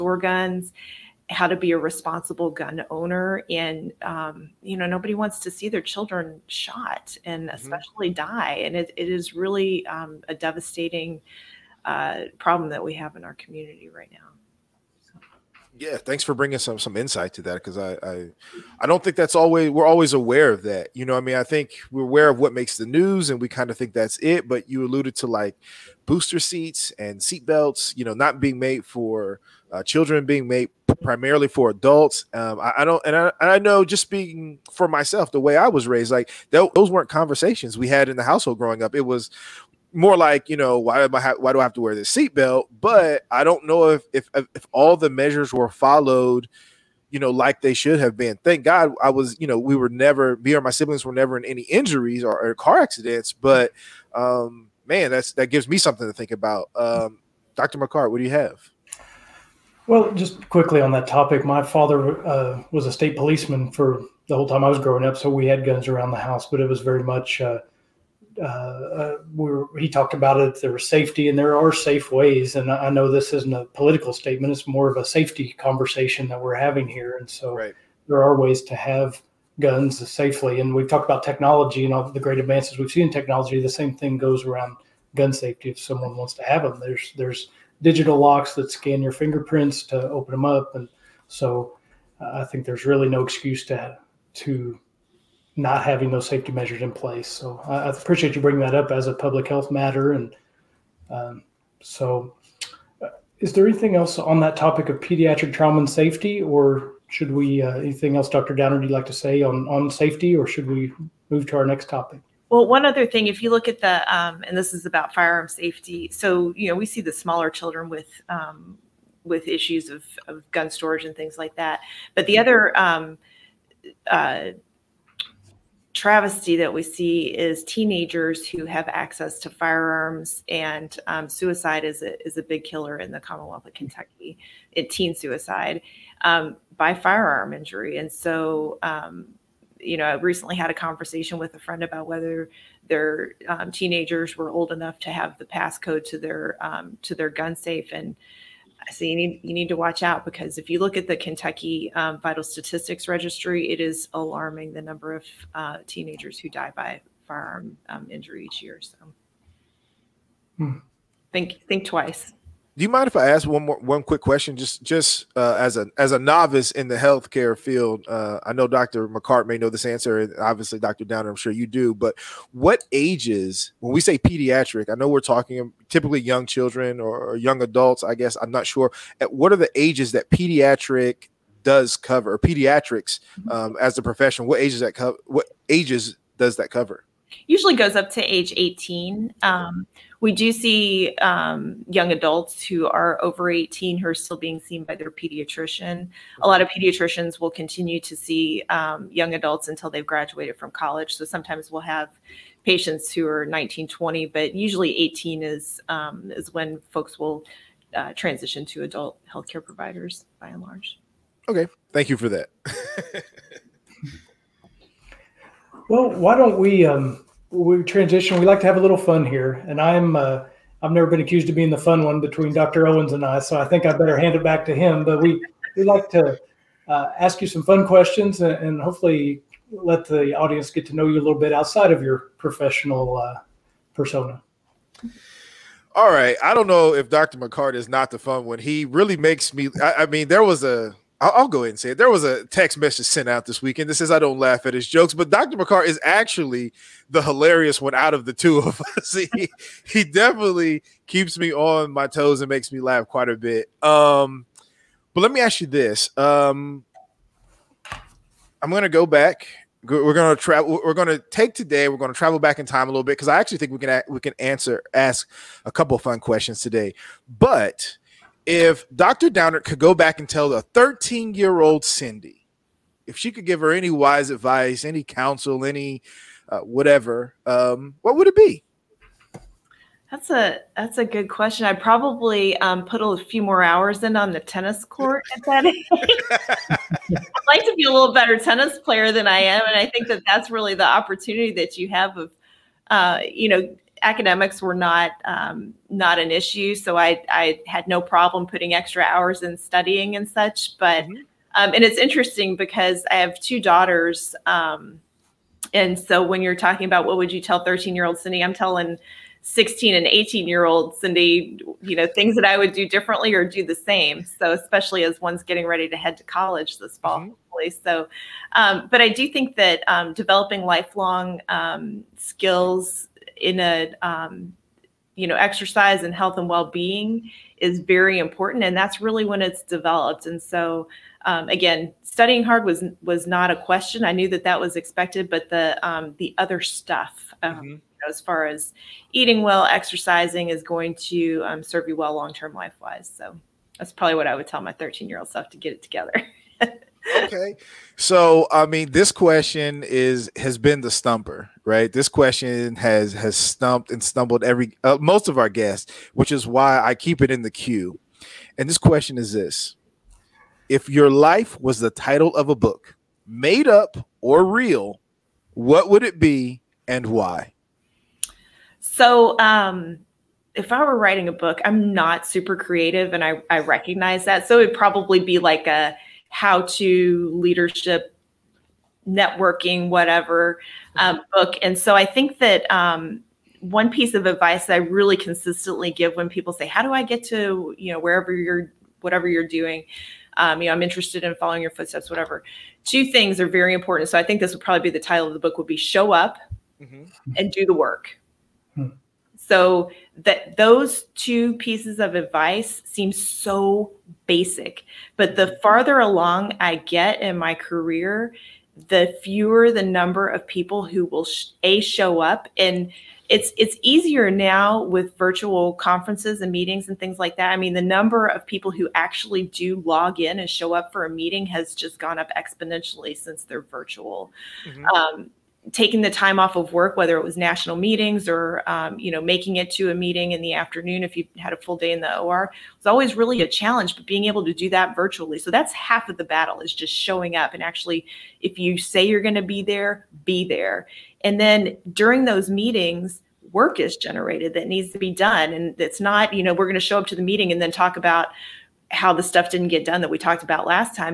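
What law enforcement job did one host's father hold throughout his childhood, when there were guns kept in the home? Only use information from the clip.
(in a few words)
State policeman.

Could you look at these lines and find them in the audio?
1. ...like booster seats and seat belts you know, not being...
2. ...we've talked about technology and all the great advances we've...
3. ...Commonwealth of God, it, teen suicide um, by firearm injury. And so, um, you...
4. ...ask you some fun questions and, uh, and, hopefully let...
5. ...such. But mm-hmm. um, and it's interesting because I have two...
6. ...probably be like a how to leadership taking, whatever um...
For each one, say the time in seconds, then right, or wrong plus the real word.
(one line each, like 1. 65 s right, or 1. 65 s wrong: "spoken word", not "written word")
1. 25 s right
2. 80 s right
3. 133 s wrong: "Kentucky", not "God"
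4. 227 s right
5. 300 s right
6. 374 s wrong: "networking", not "taking".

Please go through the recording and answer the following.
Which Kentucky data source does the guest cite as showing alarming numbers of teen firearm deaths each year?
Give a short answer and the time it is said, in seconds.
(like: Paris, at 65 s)
Vital Statistics Registry, at 152 s.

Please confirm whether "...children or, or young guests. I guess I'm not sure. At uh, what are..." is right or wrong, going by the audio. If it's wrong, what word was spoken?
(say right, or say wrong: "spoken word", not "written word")
wrong: "adults", not "guests".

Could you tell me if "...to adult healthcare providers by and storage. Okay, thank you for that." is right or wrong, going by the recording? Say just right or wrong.
wrong.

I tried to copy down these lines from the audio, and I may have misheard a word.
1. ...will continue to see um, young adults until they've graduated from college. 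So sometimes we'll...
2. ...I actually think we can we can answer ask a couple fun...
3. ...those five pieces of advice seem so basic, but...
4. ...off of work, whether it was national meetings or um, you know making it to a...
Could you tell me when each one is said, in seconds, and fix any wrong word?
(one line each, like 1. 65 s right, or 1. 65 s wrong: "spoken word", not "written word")
1. 197 s right
2. 263 s right
3. 400 s wrong: "two", not "five"
4. 426 s right.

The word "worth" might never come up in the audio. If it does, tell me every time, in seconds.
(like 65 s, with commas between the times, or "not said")
not said.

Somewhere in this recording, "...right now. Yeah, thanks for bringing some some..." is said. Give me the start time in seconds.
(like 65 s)
13 s.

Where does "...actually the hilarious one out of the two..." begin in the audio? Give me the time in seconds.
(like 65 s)
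246 s.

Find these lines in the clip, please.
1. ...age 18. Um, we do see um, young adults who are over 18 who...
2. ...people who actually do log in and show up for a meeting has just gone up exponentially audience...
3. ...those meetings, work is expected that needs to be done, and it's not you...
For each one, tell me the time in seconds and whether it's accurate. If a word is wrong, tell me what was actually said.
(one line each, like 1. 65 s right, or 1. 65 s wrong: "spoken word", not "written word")
1. 188 s right
2. 418 s wrong: "since", not "audience"
3. 442 s wrong: "generated", not "expected".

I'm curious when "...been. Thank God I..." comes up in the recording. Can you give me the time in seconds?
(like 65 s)
48 s.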